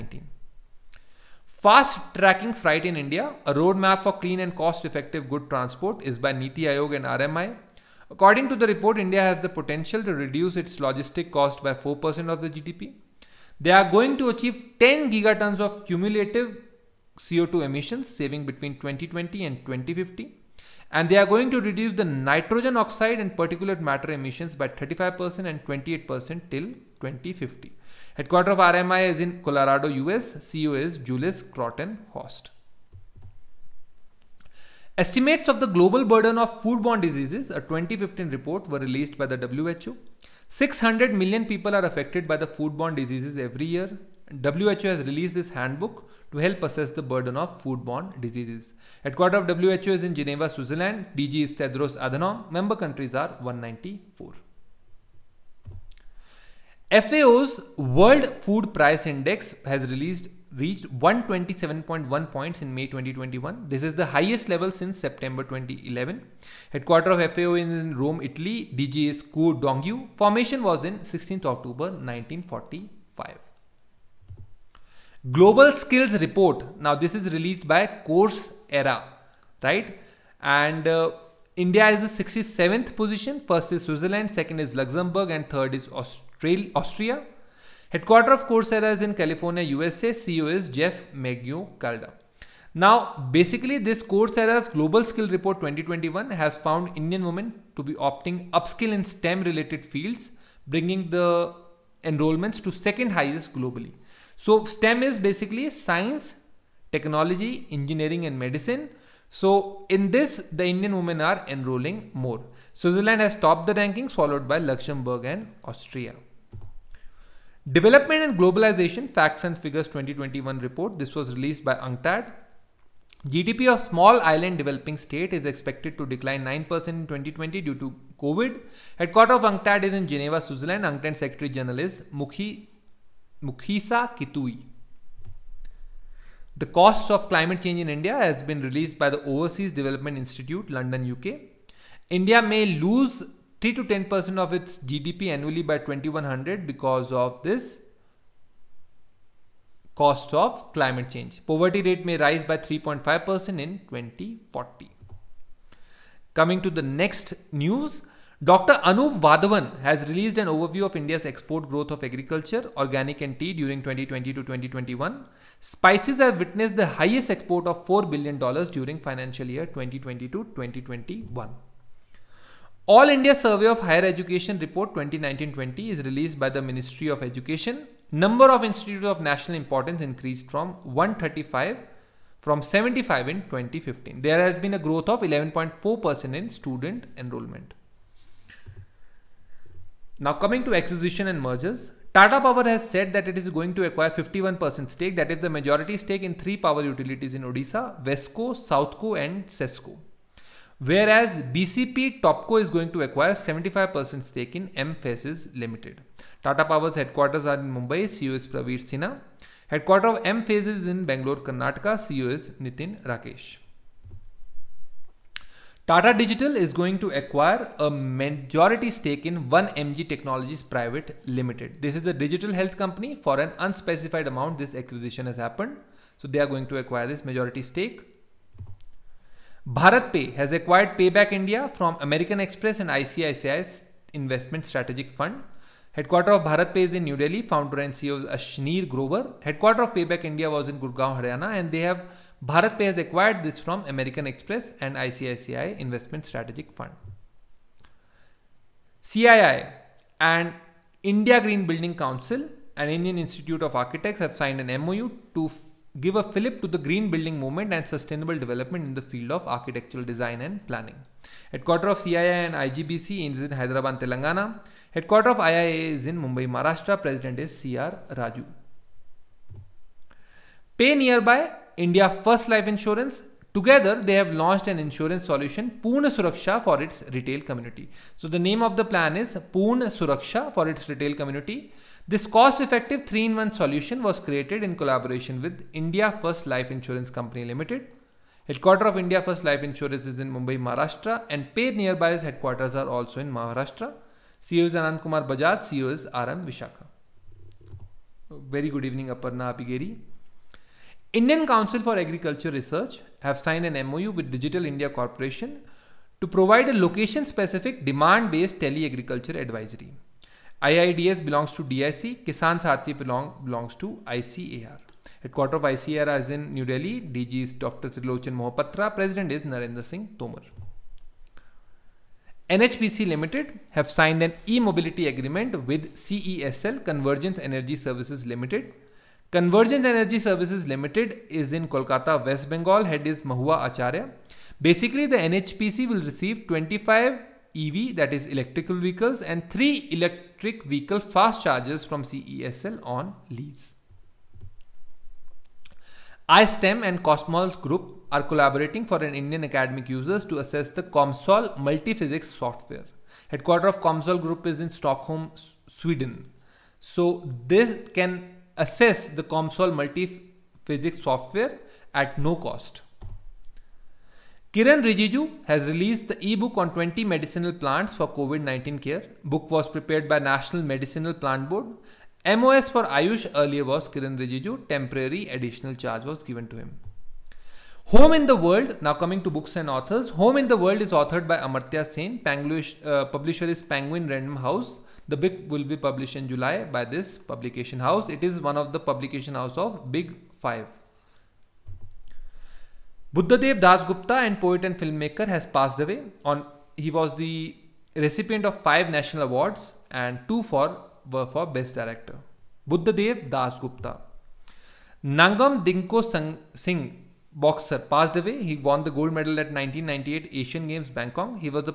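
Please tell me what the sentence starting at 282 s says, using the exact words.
This cost-effective 3-in-1 solution was created in collaboration with India First Life Insurance Company Limited.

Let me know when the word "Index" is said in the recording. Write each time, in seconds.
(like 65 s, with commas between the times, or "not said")
59 s.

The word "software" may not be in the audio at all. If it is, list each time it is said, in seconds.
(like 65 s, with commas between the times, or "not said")
352 s, 361 s.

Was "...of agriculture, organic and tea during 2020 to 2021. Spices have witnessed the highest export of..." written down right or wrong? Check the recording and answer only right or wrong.
right.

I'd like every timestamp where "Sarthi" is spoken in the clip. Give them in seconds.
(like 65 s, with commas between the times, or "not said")
312 s.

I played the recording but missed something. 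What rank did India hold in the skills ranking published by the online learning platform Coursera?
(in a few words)
67th.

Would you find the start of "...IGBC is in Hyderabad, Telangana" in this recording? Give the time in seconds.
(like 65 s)
262 s.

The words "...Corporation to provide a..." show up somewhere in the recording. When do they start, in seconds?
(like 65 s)
304 s.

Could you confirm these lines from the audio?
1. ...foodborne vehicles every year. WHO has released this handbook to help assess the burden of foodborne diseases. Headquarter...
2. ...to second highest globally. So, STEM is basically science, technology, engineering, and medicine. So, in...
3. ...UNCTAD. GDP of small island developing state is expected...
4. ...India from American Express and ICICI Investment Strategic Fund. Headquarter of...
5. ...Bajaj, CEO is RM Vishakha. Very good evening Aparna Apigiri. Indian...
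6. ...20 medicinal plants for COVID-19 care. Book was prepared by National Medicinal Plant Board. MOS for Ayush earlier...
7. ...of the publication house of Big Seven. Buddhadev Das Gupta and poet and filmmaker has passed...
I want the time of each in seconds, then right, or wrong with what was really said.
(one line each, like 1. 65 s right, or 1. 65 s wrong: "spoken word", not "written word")
1. 42 s wrong: "diseases", not "vehicles"
2. 102 s right
3. 121 s right
4. 231 s right
5. 295 s right
6. 366 s right
7. 388 s wrong: "Five", not "Seven".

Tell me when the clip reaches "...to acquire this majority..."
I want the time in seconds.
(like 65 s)
226 s.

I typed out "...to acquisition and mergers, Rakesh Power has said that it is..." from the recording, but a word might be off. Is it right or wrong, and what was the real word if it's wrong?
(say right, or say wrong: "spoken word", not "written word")
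wrong: "Tata", not "Rakesh".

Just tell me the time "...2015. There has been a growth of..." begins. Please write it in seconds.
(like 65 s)
183 s.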